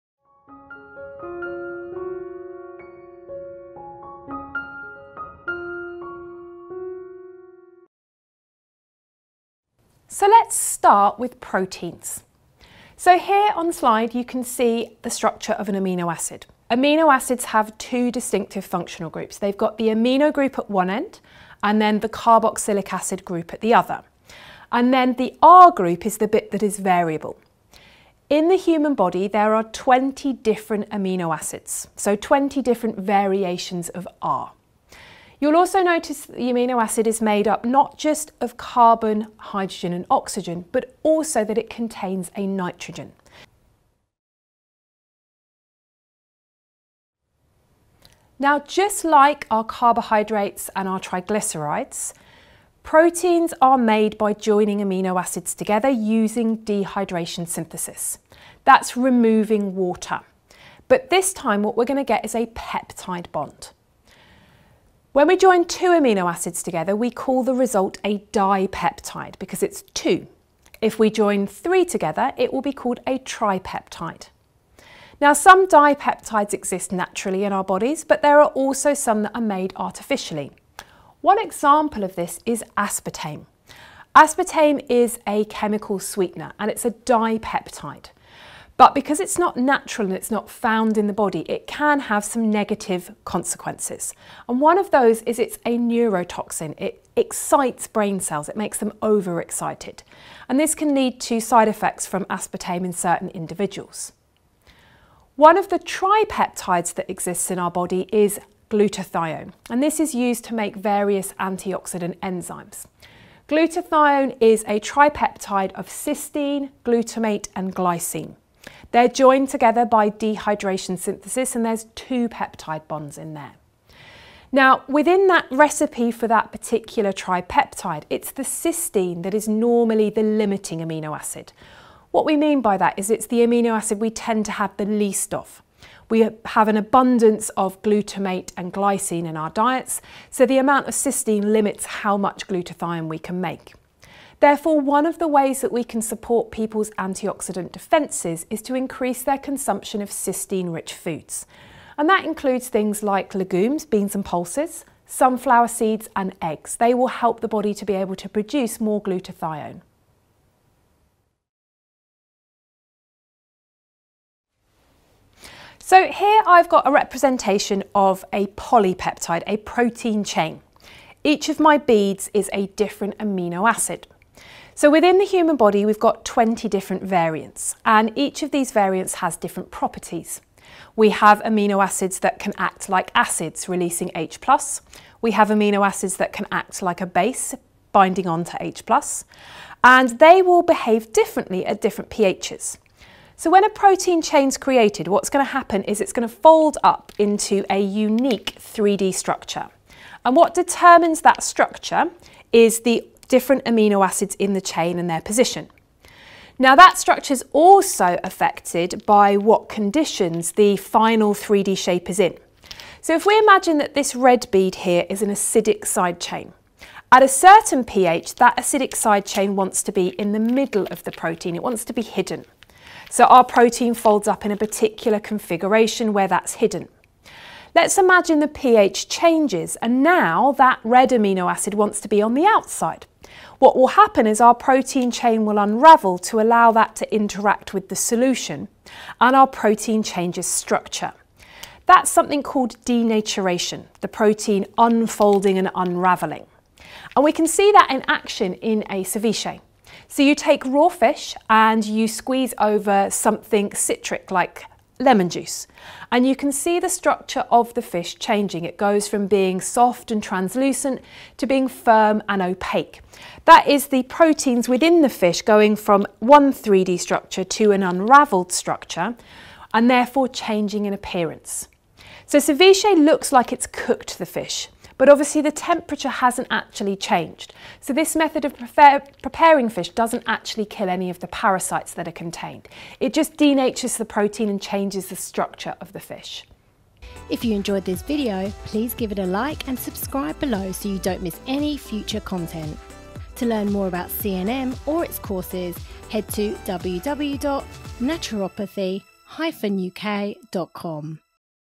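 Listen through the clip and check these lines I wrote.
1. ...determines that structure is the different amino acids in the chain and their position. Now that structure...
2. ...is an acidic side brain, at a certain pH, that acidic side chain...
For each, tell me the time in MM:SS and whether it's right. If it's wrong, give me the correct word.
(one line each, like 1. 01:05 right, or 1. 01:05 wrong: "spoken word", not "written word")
1. 03:20 right
2. 03:35 wrong: "chain", not "brain".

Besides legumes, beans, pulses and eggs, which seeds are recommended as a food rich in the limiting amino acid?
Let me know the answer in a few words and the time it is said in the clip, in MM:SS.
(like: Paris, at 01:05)
Sunflower seeds, at 02:35.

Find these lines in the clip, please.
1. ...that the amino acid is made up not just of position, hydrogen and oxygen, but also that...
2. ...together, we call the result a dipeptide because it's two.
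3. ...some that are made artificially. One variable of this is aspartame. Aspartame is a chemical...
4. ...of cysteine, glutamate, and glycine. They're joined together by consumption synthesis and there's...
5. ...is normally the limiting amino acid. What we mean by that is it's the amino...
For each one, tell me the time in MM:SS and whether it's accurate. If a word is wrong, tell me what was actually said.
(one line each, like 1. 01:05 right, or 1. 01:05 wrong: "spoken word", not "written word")
1. 00:36 wrong: "carbon", not "position"
2. 01:06 right
3. 01:18 wrong: "example", not "variable"
4. 01:55 wrong: "dehydration", not "consumption"
5. 02:09 right.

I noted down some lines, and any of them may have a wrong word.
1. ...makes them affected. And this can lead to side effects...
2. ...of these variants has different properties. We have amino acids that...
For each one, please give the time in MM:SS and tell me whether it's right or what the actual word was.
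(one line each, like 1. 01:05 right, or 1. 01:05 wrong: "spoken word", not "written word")
1. 01:38 wrong: "overexcited", not "affected"
2. 02:58 right.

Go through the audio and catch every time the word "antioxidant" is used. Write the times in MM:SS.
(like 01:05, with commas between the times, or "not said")
01:51, 02:26.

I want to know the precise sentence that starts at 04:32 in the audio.
So ceviche looks like it's cooked the fish but obviously the temperature hasn't actually changed.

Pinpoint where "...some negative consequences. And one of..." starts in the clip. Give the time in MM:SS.
01:32.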